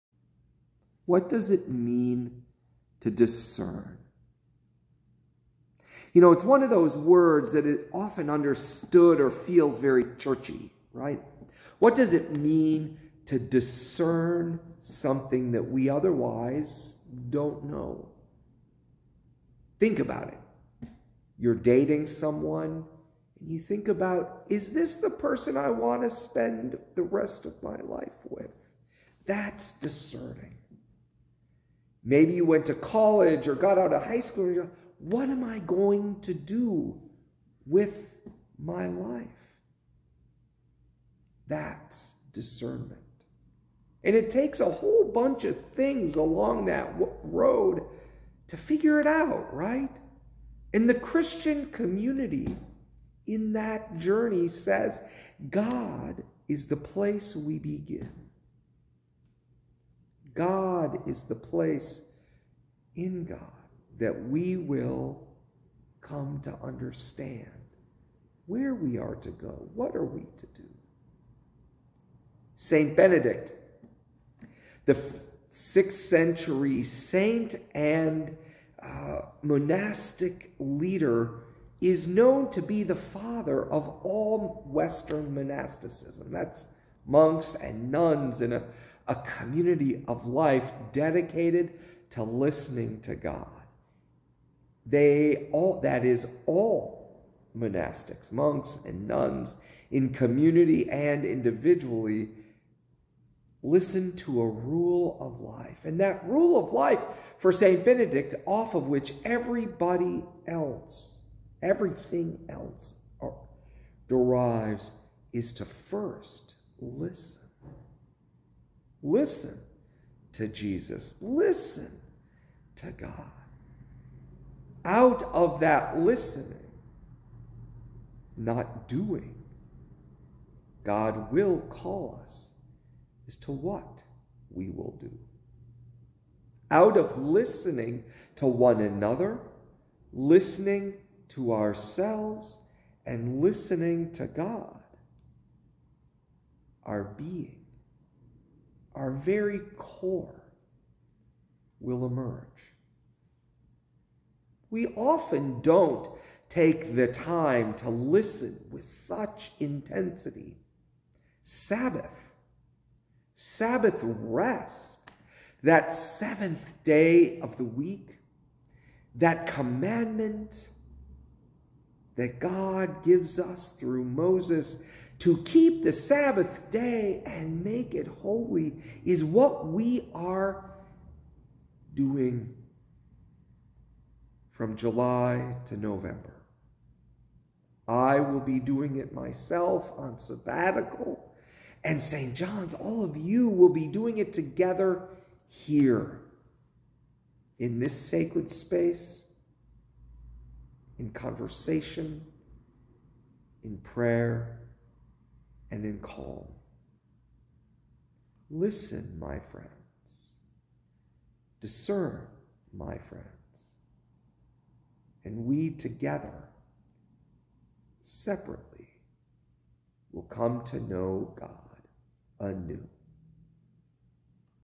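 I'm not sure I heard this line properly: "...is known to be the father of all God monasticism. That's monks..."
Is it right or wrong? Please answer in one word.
wrong.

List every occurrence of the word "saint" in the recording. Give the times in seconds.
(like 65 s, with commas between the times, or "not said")
72 s, 76 s.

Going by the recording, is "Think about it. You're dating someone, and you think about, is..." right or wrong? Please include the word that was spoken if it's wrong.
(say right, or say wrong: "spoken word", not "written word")
right.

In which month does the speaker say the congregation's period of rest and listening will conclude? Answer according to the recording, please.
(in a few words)
November.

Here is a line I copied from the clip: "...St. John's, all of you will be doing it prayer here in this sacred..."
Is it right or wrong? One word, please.
wrong.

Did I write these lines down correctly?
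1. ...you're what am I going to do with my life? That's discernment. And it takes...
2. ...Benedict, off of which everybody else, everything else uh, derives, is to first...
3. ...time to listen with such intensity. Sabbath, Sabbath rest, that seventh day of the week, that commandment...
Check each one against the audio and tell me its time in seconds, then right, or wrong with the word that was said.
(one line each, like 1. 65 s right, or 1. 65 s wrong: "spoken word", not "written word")
1. 34 s right
2. 107 s right
3. 157 s right.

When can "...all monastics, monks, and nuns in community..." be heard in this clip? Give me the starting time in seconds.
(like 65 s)
96 s.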